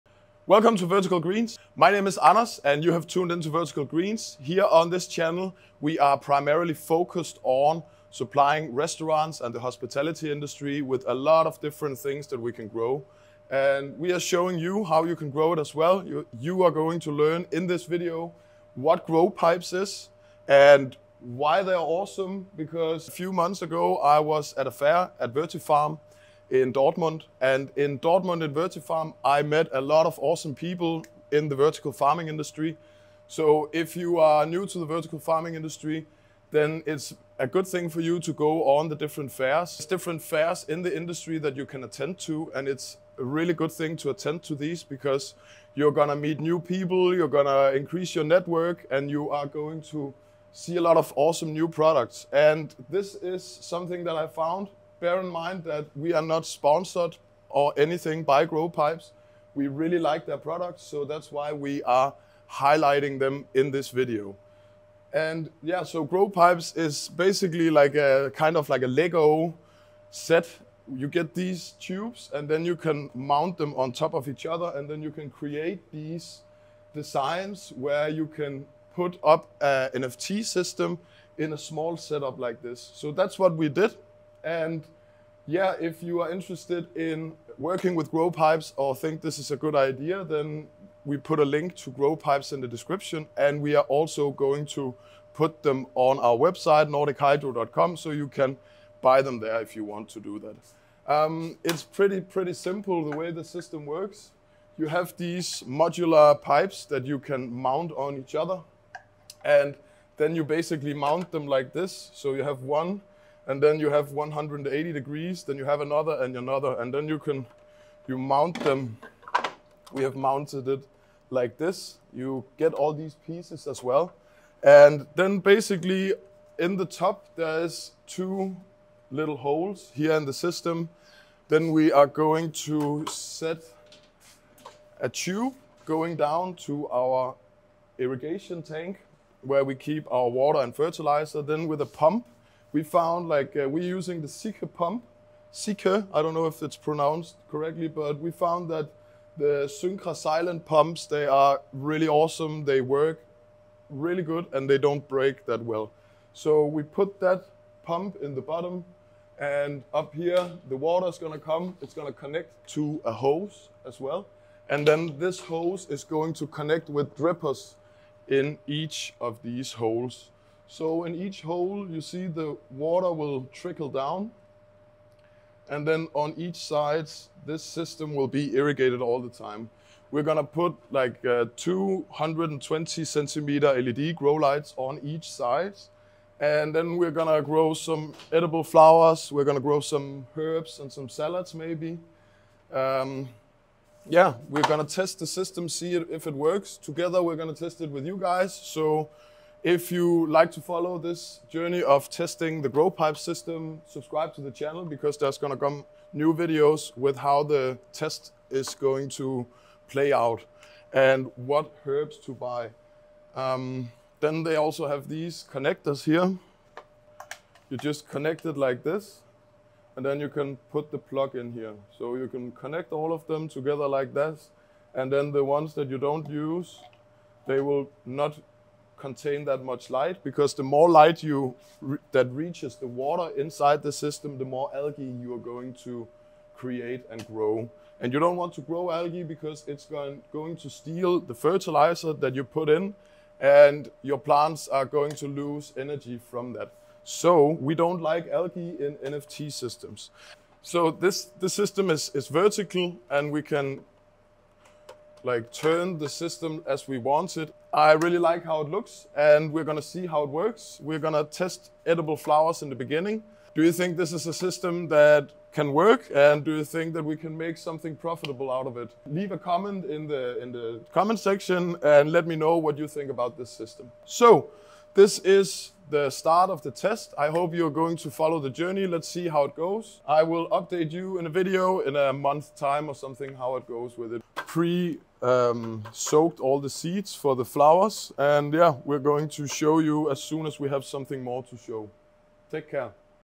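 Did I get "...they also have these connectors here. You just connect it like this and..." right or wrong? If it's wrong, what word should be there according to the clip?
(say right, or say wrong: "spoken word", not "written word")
right.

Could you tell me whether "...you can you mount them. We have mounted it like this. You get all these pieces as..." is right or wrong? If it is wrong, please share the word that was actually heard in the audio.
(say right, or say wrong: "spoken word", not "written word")
right.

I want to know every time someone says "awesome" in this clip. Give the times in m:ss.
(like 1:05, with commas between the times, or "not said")
0:21, 0:30, 0:51, 2:32.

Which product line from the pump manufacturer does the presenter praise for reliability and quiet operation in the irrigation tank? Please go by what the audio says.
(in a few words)
Syncra silent.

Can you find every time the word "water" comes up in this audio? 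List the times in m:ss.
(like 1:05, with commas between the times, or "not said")
2:20, 2:40, 2:52, 3:53.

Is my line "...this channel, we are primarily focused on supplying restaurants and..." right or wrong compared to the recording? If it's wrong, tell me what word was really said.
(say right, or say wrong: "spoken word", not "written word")
right.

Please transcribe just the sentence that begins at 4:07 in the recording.
So we don't like algae in NFT systems.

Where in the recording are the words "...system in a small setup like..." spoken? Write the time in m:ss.
1:20.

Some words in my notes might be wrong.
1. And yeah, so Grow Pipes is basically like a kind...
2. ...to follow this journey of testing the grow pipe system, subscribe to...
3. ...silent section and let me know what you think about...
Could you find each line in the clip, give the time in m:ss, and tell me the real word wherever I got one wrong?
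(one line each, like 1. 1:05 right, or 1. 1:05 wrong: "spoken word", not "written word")
1. 1:05 right
2. 3:20 right
3. 4:30 wrong: "comment", not "silent".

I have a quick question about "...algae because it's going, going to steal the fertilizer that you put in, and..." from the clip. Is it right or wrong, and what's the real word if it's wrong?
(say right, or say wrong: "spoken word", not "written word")
right.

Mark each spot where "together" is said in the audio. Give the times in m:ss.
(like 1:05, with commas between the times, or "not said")
3:16, 3:43.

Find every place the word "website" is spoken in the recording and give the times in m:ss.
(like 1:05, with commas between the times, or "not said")
1:36.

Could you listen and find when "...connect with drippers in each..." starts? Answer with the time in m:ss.
2:46.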